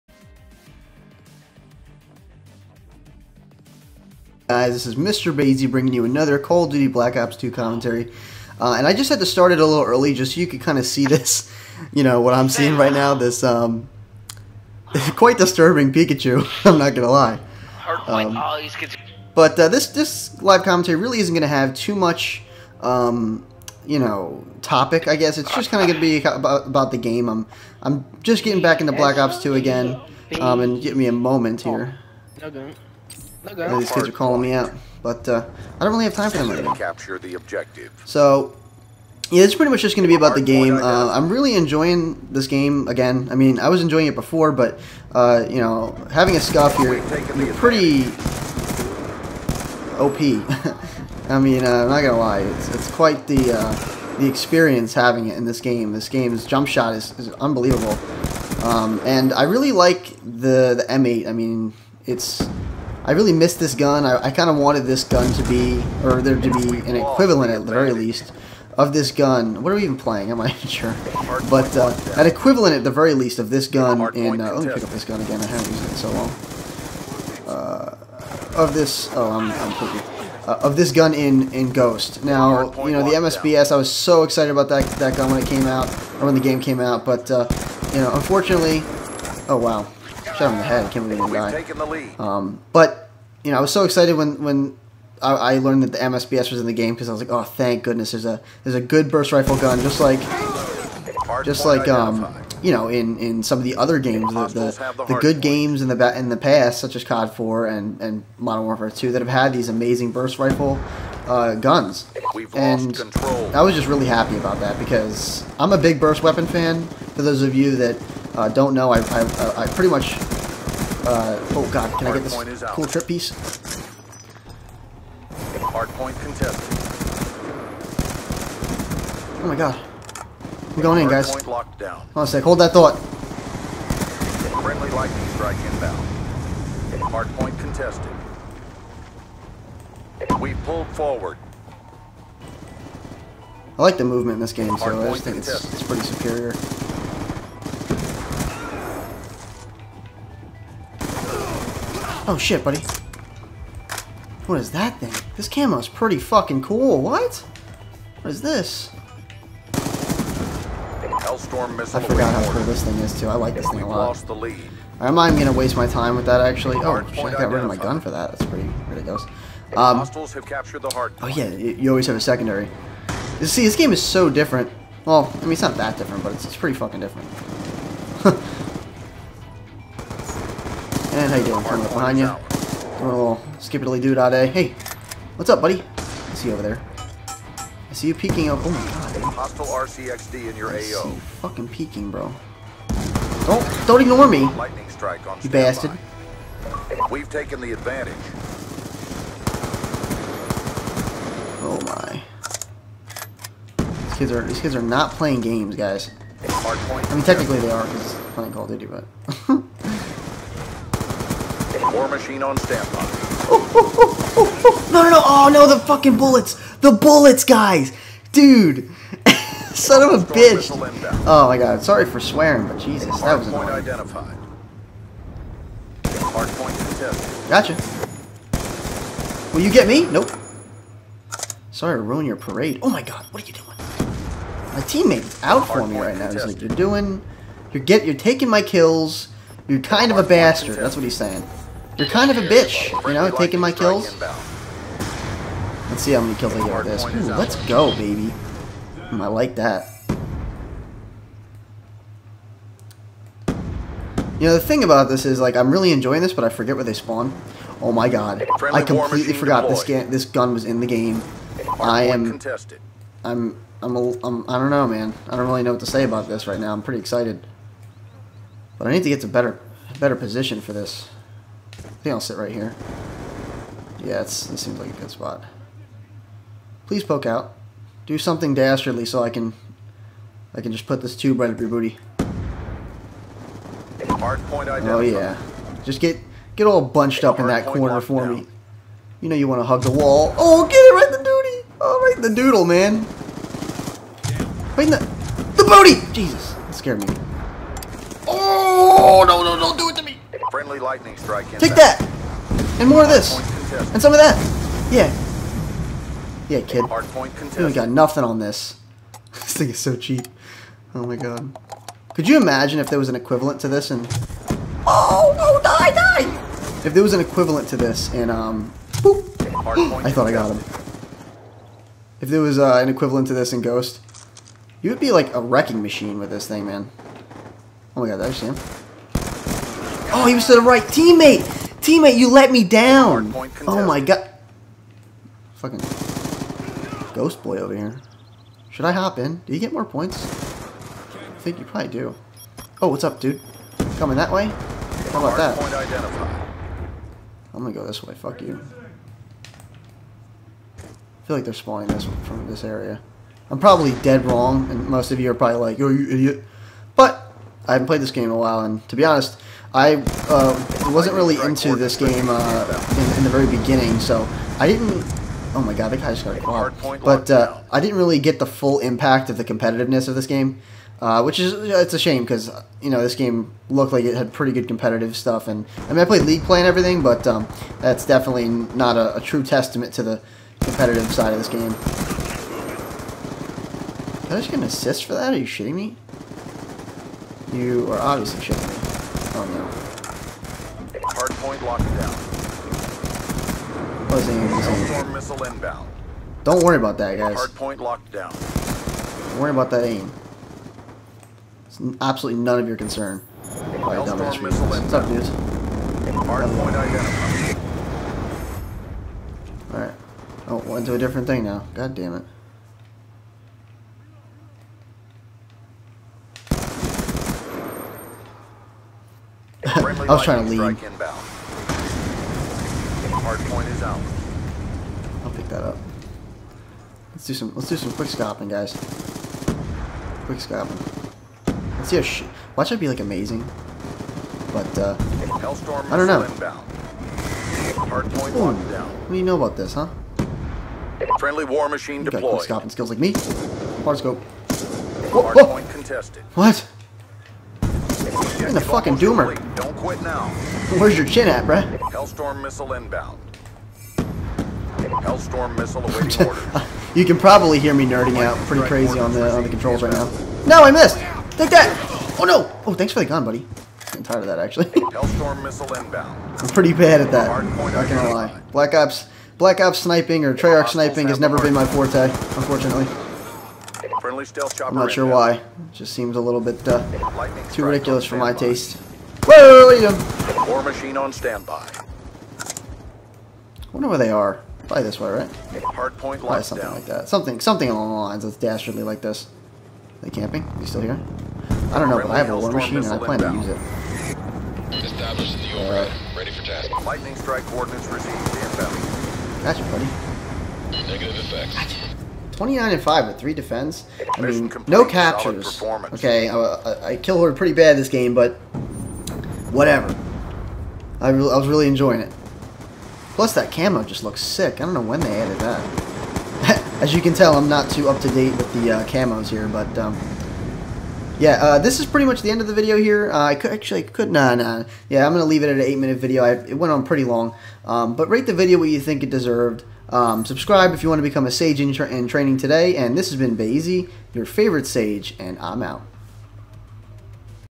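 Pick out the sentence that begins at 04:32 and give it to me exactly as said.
I think I'll sit right here.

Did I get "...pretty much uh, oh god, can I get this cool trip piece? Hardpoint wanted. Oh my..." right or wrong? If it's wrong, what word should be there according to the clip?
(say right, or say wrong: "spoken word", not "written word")
wrong: "contested", not "wanted".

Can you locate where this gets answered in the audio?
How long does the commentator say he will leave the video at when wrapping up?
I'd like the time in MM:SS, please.
08:45.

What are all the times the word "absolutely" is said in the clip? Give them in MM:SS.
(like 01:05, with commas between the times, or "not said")
06:42.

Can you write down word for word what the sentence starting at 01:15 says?
I haven't used it in so long.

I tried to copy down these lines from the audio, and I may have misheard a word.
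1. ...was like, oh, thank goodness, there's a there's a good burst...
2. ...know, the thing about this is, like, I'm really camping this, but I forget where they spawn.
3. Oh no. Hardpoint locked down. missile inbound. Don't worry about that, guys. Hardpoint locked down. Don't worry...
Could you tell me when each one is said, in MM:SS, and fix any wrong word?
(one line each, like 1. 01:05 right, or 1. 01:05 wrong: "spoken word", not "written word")
1. 01:37 right
2. 04:14 wrong: "enjoying", not "camping"
3. 06:29 right.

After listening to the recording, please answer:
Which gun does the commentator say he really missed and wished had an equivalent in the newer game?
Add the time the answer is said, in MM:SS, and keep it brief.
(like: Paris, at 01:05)
M8, at 01:00.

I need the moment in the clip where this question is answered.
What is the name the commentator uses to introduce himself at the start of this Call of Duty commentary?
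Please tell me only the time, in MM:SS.
00:04.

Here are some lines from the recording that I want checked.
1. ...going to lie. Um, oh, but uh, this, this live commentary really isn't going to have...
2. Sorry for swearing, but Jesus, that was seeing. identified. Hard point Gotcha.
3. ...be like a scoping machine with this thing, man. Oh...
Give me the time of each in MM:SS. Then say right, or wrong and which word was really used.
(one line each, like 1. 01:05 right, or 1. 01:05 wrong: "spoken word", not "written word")
1. 00:16 right
2. 03:41 wrong: "annoying", not "seeing"
3. 05:24 wrong: "wrecking", not "scoping".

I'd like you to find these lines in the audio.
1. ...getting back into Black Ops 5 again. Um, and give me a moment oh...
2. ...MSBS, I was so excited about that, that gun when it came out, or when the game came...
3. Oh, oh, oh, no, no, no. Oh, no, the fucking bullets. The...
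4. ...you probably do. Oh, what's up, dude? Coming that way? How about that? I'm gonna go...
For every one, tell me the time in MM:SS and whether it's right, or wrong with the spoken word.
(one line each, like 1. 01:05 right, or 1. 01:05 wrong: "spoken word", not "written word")
1. 00:28 wrong: "2", not "5"
2. 01:23 right
3. 03:33 right
4. 05:41 right.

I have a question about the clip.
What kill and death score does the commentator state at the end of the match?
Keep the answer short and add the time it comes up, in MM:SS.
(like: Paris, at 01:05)
29 and 5, at 08:22.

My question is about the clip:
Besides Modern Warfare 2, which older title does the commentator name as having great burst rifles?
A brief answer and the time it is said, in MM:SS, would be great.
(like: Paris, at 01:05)
COD 4, at 01:47.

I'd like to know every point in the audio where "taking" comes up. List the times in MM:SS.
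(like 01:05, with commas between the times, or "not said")
03:58, 04:03.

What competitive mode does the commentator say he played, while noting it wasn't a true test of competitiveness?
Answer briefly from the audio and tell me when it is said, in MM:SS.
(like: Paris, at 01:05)
League play, at 06:16.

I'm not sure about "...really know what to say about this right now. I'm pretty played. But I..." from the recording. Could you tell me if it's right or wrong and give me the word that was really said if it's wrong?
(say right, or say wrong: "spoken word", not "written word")
wrong: "excited", not "played".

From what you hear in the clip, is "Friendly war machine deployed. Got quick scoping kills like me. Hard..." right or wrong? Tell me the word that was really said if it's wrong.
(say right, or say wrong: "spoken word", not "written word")
wrong: "skills", not "kills".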